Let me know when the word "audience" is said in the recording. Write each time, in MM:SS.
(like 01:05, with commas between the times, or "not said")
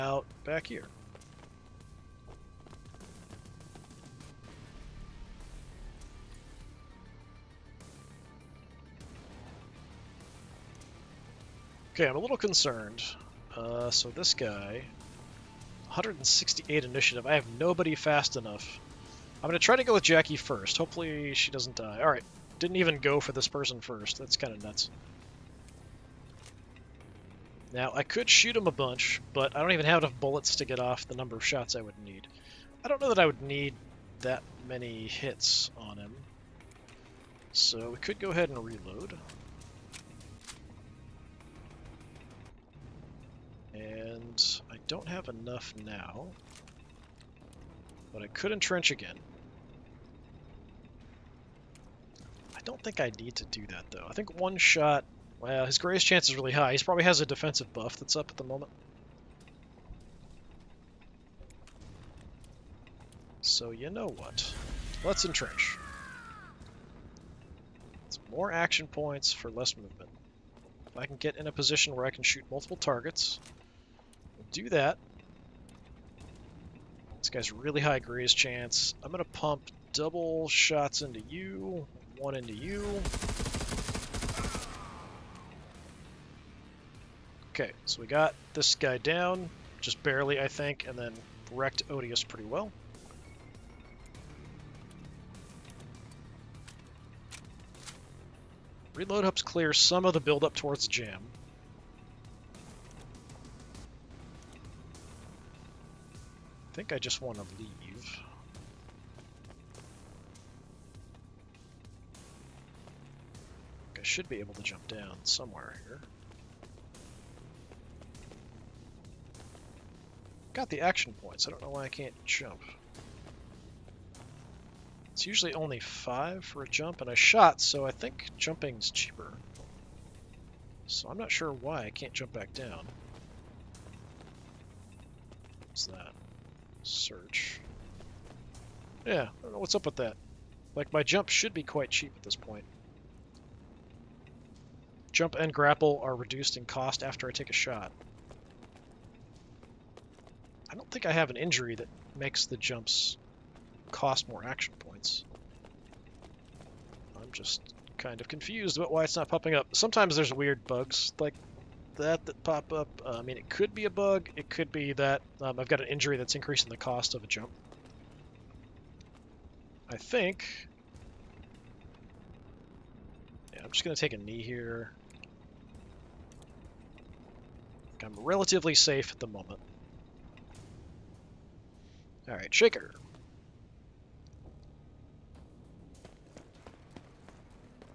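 not said.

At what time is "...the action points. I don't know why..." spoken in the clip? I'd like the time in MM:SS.
02:00.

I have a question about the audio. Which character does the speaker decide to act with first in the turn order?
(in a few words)
Jackie.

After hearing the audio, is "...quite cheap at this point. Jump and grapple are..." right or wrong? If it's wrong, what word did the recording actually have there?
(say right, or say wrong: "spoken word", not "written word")
right.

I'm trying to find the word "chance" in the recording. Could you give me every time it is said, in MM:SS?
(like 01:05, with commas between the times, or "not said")
00:56, 01:18.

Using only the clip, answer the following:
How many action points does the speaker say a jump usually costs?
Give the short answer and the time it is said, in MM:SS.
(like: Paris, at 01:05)
5, at 02:05.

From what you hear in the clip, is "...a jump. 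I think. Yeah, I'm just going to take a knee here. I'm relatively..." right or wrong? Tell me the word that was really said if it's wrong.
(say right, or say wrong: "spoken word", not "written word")
right.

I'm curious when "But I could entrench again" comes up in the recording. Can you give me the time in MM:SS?
00:48.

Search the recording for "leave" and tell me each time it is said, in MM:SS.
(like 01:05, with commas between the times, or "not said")
01:47.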